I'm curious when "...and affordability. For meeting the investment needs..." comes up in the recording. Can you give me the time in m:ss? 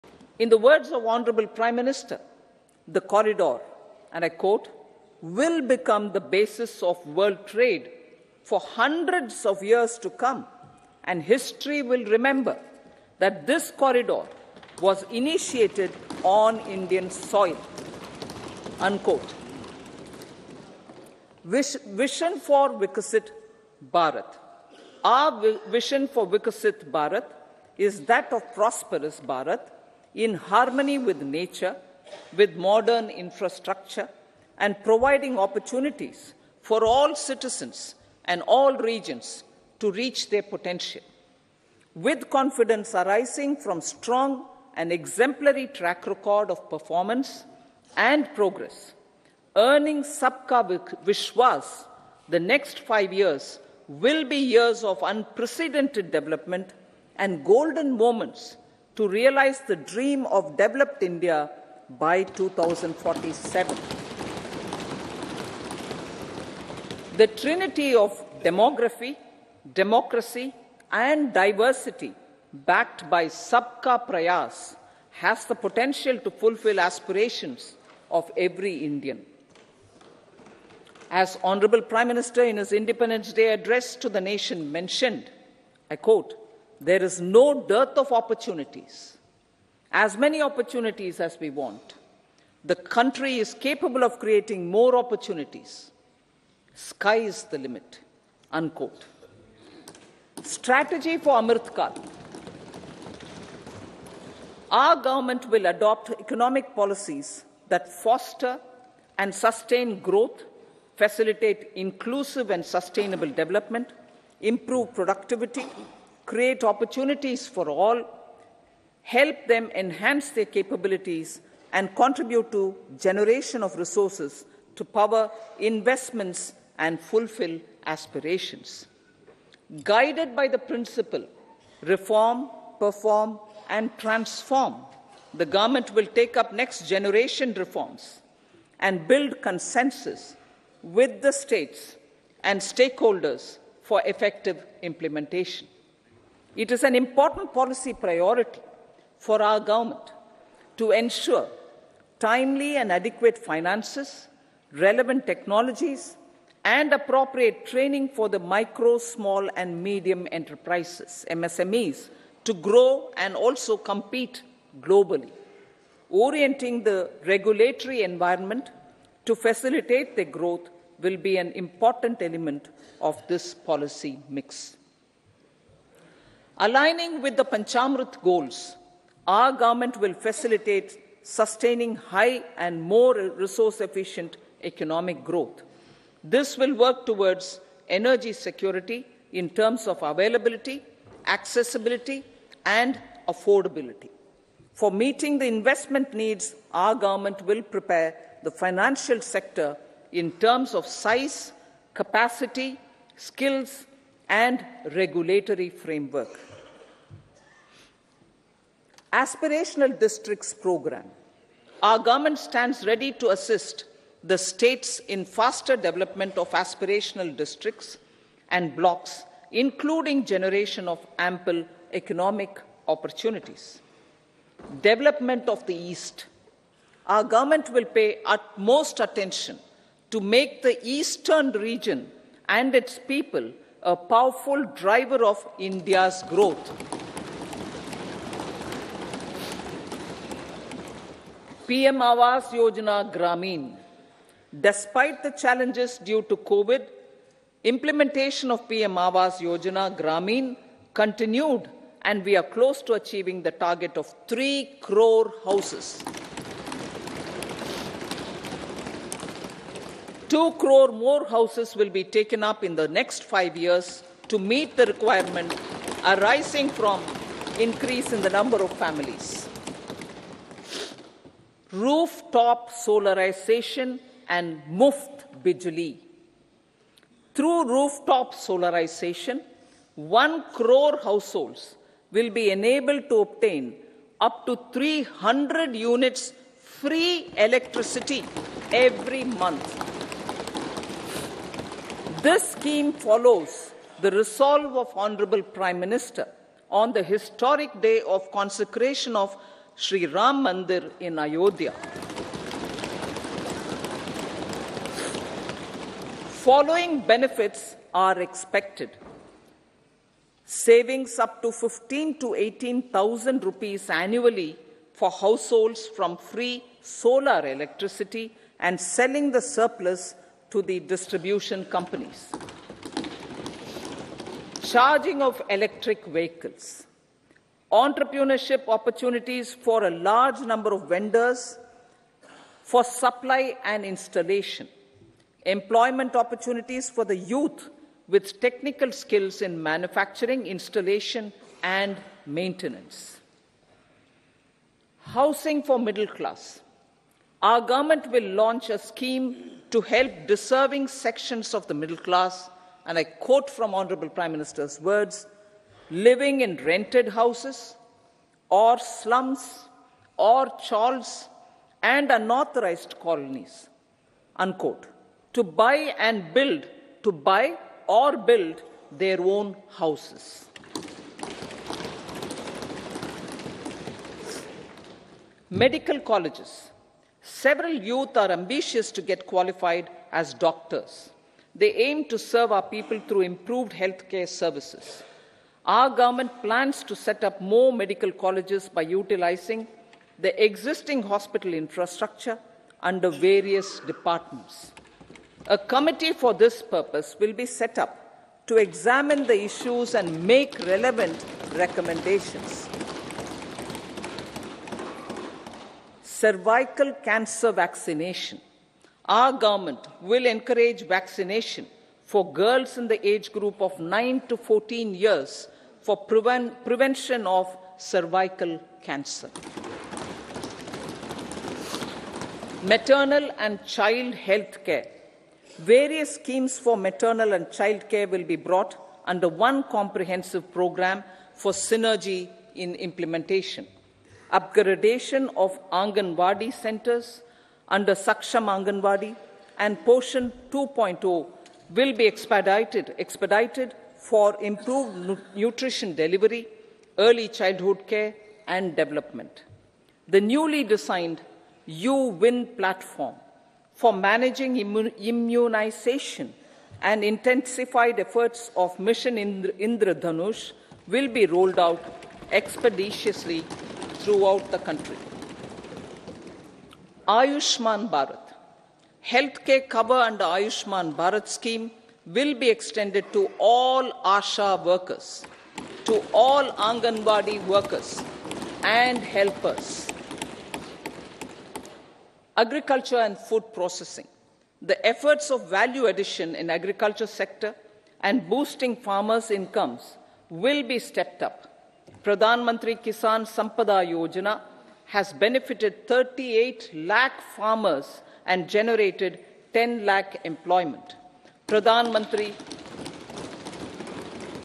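3:12.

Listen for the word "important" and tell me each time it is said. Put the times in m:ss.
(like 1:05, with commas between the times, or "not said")
2:26, 2:51.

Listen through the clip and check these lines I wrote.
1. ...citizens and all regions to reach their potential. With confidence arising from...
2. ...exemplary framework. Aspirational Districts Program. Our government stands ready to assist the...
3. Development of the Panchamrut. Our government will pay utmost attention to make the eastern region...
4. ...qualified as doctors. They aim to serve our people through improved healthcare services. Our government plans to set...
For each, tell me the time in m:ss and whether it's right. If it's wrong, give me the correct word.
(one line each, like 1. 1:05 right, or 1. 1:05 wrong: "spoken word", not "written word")
1. 0:37 right
2. 3:24 wrong: "regulatory", not "exemplary"
3. 3:44 wrong: "East", not "Panchamrut"
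4. 6:19 right.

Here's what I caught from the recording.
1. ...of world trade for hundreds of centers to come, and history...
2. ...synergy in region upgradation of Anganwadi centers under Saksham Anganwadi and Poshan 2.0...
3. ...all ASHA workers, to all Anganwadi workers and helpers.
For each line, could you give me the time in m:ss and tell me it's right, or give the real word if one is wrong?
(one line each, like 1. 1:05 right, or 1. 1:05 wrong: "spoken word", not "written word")
1. 0:06 wrong: "years", not "centers"
2. 7:11 wrong: "implementation", not "region"
3. 7:53 right.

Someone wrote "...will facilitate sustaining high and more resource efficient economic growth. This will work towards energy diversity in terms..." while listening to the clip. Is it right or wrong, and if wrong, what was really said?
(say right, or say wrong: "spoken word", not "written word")
wrong: "security", not "diversity".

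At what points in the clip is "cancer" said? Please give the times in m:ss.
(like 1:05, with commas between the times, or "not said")
6:47, 6:58.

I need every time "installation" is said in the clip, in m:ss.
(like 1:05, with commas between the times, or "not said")
5:33, 5:40.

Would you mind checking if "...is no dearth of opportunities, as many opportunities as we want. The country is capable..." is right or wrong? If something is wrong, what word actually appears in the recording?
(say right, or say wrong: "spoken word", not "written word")
right.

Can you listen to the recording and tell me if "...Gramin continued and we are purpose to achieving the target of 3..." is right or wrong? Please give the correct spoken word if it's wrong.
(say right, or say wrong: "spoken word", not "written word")
wrong: "close", not "purpose".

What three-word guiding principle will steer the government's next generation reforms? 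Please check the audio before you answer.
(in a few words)
reform, perform, and transform.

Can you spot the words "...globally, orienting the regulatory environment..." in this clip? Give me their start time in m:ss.
2:44.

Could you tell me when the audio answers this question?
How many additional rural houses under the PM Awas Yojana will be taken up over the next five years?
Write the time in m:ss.
4:20.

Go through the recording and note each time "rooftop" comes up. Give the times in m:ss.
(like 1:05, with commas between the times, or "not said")
4:31, 4:37.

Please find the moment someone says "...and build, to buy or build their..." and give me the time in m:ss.
6:05.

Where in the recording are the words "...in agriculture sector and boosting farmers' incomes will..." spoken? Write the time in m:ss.
8:06.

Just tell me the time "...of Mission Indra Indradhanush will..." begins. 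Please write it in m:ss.
7:38.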